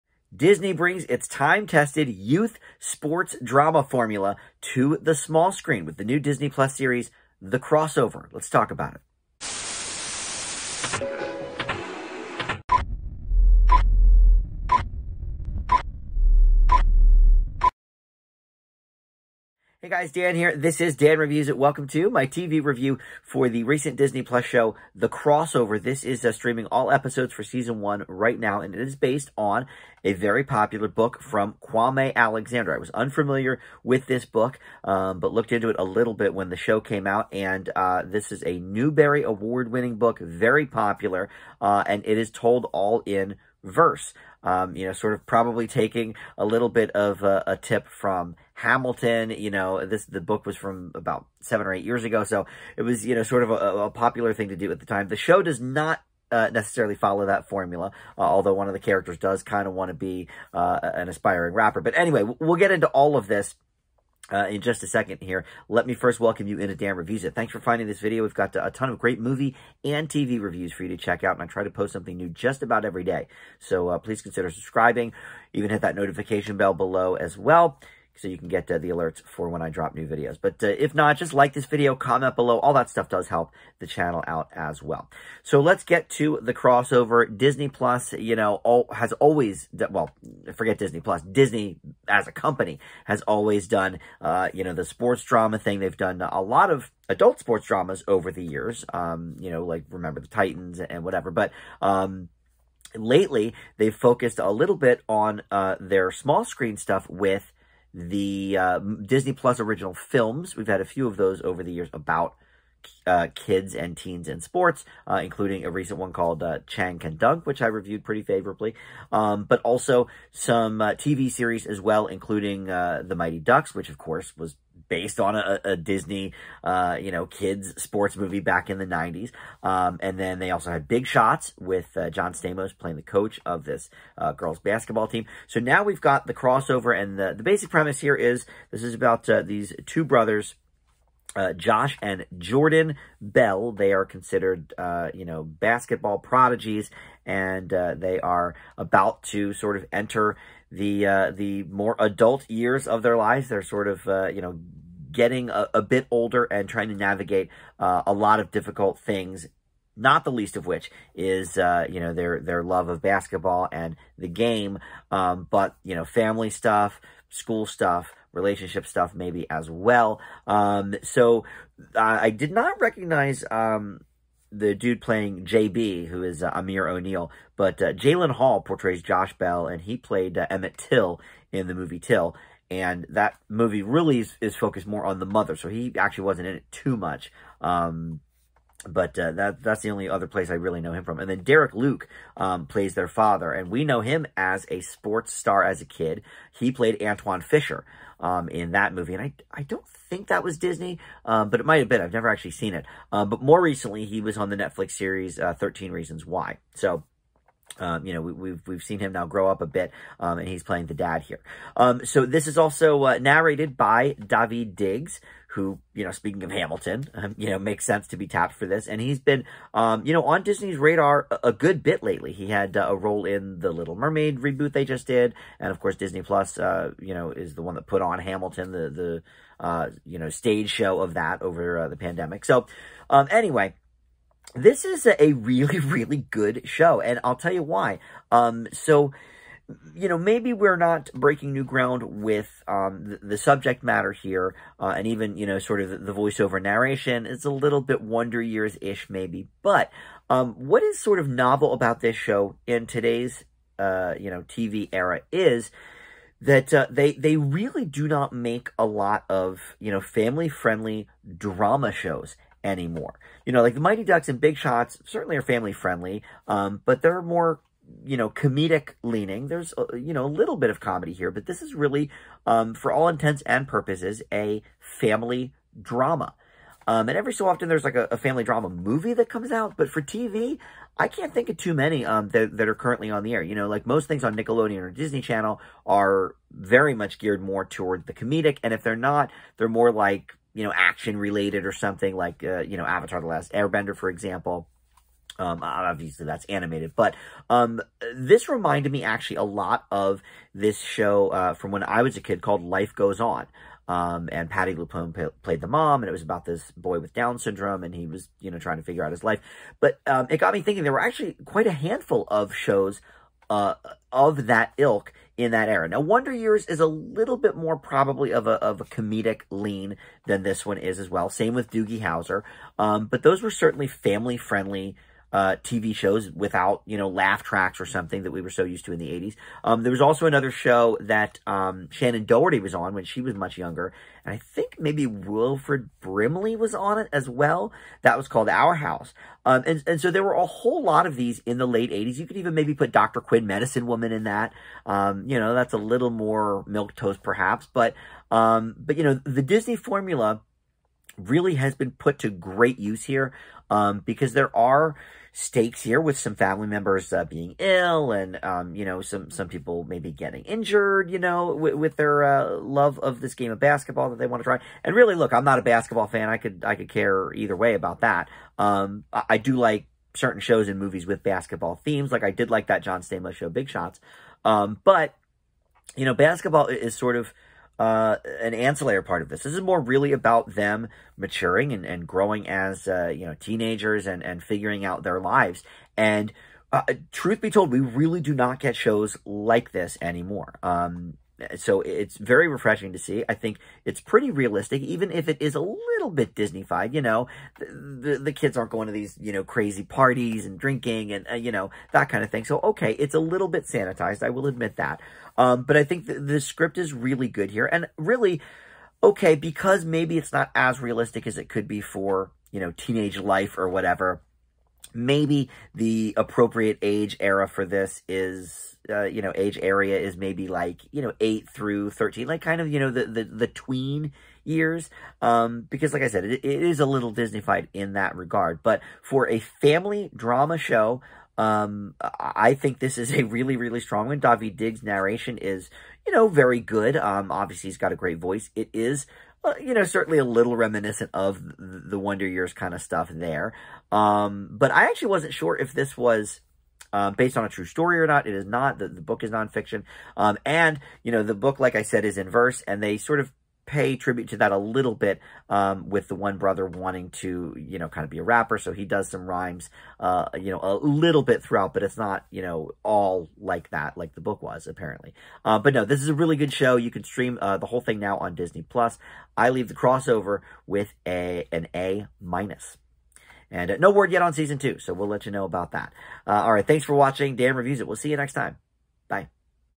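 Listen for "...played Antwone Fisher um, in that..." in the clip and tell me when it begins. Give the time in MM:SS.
03:16.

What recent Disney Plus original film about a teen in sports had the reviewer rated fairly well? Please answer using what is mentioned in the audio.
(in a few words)
Chang Can Dunk.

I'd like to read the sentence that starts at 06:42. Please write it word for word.
So okay, it's a little bit sanitized.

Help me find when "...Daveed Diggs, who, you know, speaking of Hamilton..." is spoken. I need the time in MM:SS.
03:34.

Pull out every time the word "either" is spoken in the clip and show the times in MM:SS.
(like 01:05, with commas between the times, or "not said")
06:07.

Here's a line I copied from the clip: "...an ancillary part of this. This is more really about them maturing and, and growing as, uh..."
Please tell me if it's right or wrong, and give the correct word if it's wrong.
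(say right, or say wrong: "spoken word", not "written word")
right.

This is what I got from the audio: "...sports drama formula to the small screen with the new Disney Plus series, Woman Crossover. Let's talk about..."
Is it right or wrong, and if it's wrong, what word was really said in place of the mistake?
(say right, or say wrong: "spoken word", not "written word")
wrong: "The", not "Woman".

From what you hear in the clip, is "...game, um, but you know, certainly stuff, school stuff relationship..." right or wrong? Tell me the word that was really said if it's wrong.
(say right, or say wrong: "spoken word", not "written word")
wrong: "family", not "certainly".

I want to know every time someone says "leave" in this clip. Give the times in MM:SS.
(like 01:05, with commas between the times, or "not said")
07:49.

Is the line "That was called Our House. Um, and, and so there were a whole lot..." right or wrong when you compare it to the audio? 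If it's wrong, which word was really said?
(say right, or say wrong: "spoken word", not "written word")
right.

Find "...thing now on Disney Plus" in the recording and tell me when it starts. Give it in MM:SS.
07:47.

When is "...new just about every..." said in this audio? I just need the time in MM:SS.
01:12.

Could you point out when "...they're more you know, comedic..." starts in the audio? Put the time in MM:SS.
04:27.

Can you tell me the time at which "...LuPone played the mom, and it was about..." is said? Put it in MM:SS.
05:04.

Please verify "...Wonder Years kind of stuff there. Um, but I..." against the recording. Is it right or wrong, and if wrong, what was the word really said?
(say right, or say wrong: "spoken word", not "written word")
right.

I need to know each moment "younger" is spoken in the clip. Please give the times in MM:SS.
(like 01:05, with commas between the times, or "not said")
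05:33.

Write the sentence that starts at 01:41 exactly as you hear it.
But, um, lately they've focused a little bit on uh, their small screen stuff with the uh, Disney Plus original films.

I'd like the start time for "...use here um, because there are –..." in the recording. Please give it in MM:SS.
05:52.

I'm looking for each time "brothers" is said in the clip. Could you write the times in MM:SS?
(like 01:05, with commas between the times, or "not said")
02:20, 07:36.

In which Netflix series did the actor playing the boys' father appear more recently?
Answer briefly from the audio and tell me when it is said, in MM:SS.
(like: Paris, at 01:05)
Thirteen Reasons Why, at 03:25.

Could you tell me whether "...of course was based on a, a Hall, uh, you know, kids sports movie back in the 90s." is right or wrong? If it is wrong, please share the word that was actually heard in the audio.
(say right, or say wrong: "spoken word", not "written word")
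wrong: "Disney", not "Hall".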